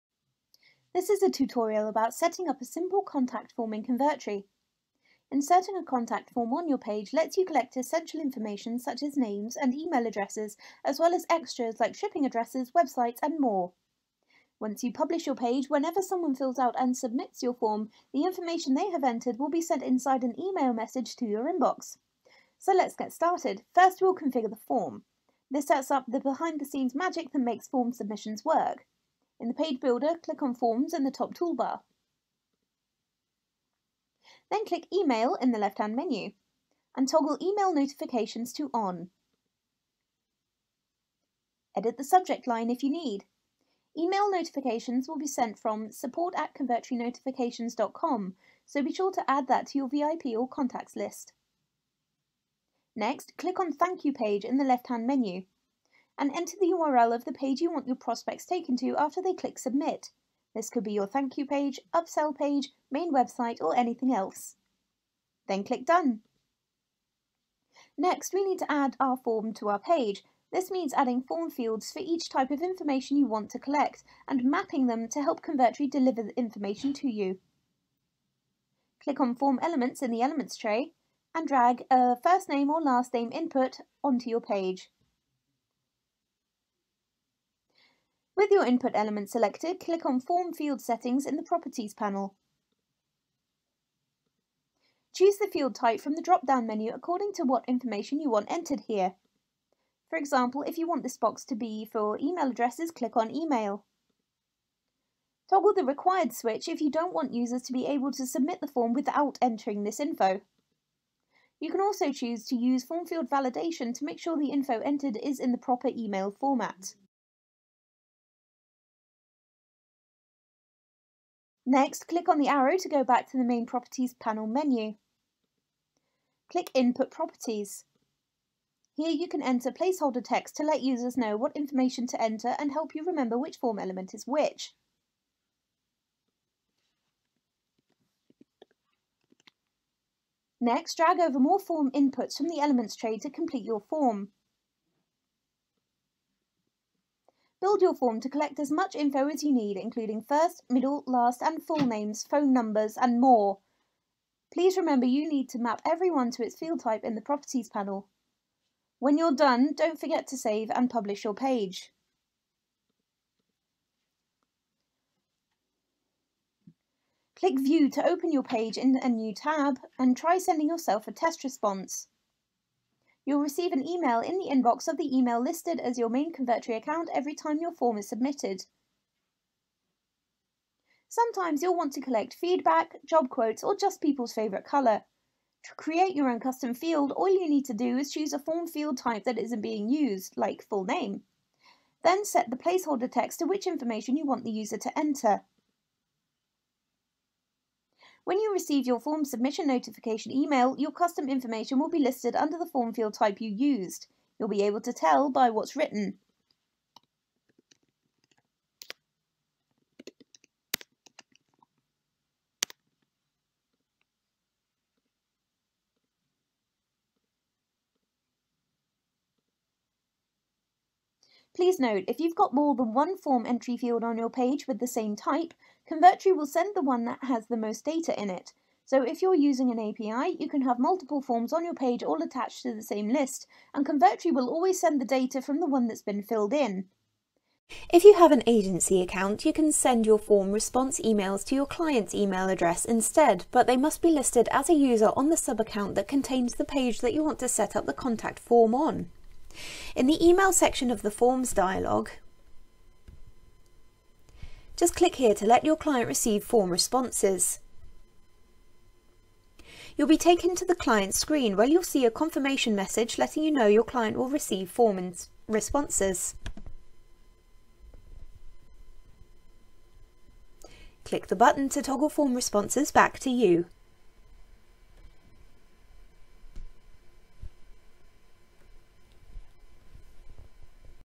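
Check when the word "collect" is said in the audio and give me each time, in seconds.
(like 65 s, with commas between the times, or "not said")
7 s, 73 s, 148 s, 182 s.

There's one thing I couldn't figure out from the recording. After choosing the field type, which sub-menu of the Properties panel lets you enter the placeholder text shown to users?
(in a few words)
Input Properties.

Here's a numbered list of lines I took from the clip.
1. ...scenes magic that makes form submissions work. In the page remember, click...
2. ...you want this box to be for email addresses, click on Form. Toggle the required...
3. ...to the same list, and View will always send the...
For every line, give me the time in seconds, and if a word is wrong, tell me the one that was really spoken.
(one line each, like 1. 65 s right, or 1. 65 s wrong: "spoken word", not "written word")
1. 26 s wrong: "builder", not "remember"
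2. 100 s wrong: "Email", not "Form"
3. 232 s wrong: "Convertri", not "View".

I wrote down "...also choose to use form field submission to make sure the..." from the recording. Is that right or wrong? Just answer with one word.
wrong.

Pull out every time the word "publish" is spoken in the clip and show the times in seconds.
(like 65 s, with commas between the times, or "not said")
14 s, 160 s.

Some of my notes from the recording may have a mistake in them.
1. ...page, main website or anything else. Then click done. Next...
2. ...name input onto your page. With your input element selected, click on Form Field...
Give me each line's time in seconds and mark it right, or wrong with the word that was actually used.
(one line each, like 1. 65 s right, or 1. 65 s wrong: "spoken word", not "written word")
1. 62 s right
2. 83 s right.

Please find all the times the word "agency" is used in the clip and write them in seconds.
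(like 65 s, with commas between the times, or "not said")
238 s.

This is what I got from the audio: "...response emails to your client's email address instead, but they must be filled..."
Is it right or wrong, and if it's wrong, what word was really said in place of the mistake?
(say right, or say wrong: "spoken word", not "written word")
wrong: "listed", not "filled".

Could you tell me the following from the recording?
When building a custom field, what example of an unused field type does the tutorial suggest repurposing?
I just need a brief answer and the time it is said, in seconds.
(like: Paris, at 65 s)
Full name, at 190 s.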